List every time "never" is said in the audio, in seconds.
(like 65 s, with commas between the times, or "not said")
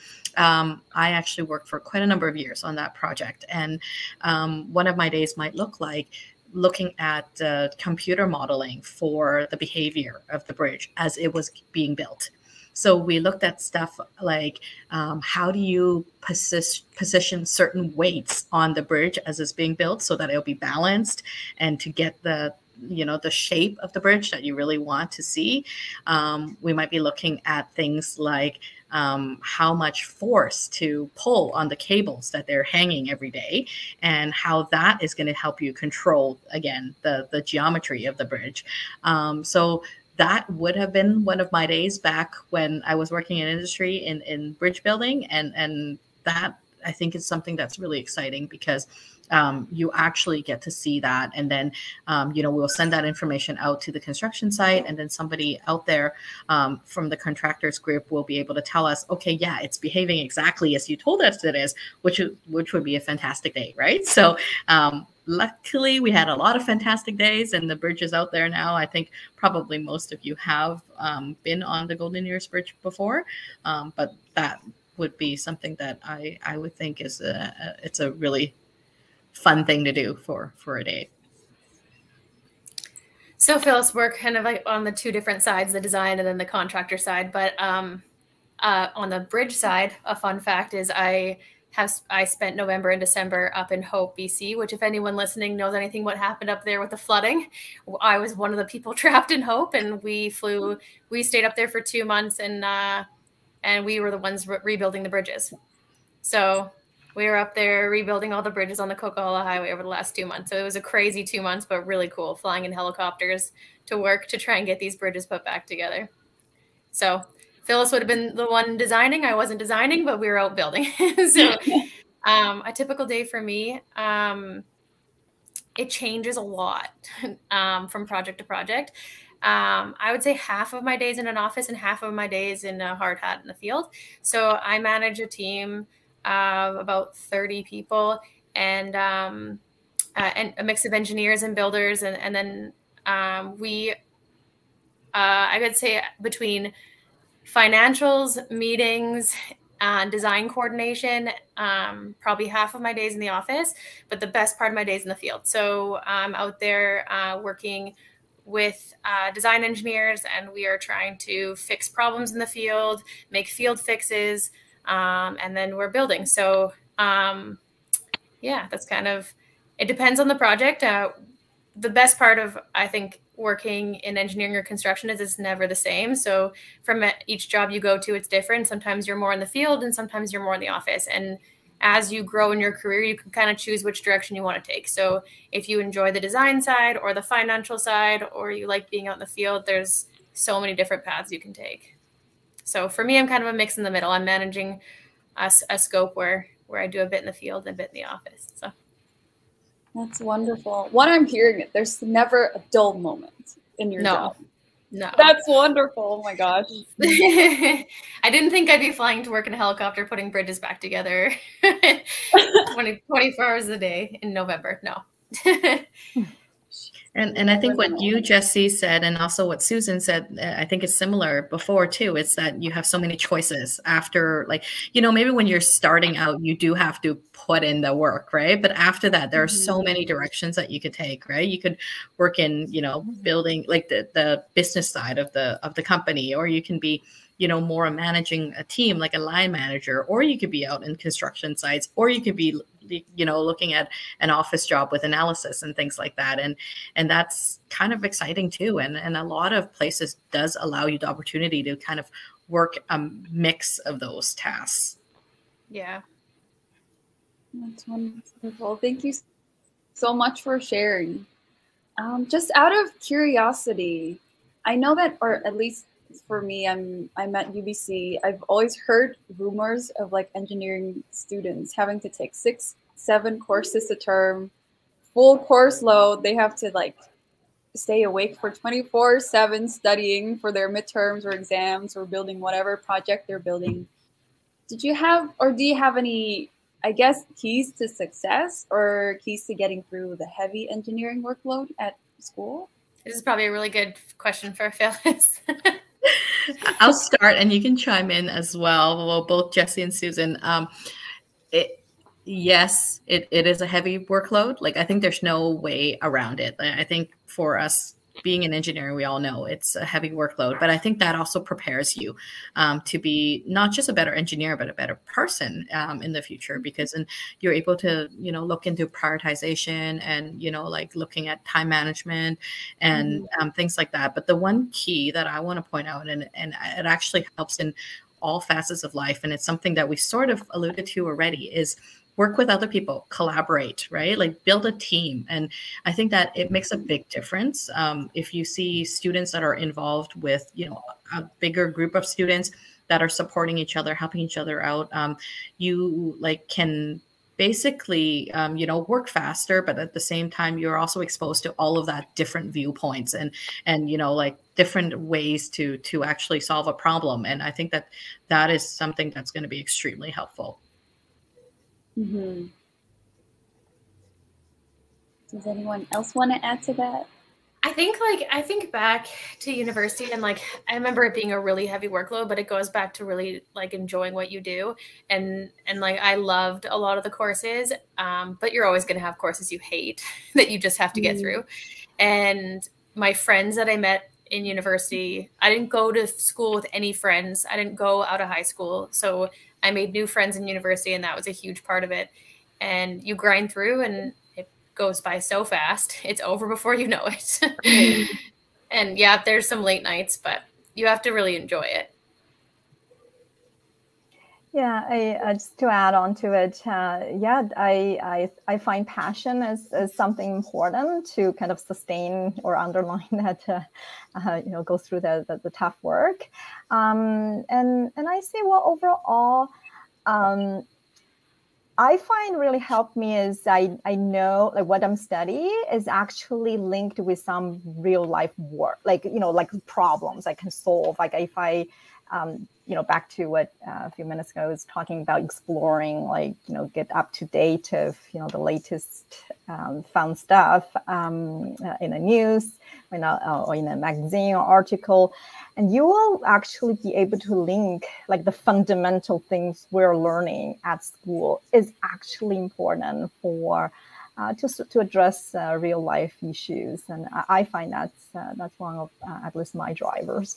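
175 s, 202 s.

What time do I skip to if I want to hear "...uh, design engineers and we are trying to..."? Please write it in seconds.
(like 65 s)
159 s.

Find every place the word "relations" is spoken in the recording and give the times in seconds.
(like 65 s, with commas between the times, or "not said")
not said.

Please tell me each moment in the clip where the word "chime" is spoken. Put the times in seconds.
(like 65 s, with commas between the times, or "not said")
297 s.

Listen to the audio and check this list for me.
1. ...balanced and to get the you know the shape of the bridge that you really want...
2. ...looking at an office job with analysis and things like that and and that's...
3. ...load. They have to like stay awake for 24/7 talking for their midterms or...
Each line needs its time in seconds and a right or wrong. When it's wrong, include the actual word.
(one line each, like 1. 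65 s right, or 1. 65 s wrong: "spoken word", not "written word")
1. 20 s right
2. 243 s right
3. 275 s wrong: "studying", not "talking".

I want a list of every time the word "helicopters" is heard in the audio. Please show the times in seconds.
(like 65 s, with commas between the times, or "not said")
112 s, 209 s.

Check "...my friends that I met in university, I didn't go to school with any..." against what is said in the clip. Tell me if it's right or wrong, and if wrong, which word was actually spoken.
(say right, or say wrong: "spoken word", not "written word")
right.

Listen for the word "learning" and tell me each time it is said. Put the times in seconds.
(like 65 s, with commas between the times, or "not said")
449 s.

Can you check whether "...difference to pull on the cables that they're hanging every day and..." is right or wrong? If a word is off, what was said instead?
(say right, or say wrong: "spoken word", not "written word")
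wrong: "force", not "difference".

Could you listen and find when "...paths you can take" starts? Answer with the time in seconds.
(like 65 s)
191 s.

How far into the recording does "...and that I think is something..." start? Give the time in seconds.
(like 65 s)
45 s.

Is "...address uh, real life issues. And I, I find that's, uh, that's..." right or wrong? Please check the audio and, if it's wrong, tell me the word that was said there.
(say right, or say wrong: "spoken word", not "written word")
right.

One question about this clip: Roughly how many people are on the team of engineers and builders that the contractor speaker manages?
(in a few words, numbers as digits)
30.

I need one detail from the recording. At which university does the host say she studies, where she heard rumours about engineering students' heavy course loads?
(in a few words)
UBC.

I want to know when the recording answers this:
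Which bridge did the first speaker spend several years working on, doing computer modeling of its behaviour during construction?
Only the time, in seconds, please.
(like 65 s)
71 s.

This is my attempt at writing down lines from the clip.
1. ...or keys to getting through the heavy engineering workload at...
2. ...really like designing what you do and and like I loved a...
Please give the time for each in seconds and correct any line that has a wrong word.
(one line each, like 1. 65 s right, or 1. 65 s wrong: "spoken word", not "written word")
1. 288 s right
2. 373 s wrong: "enjoying", not "designing".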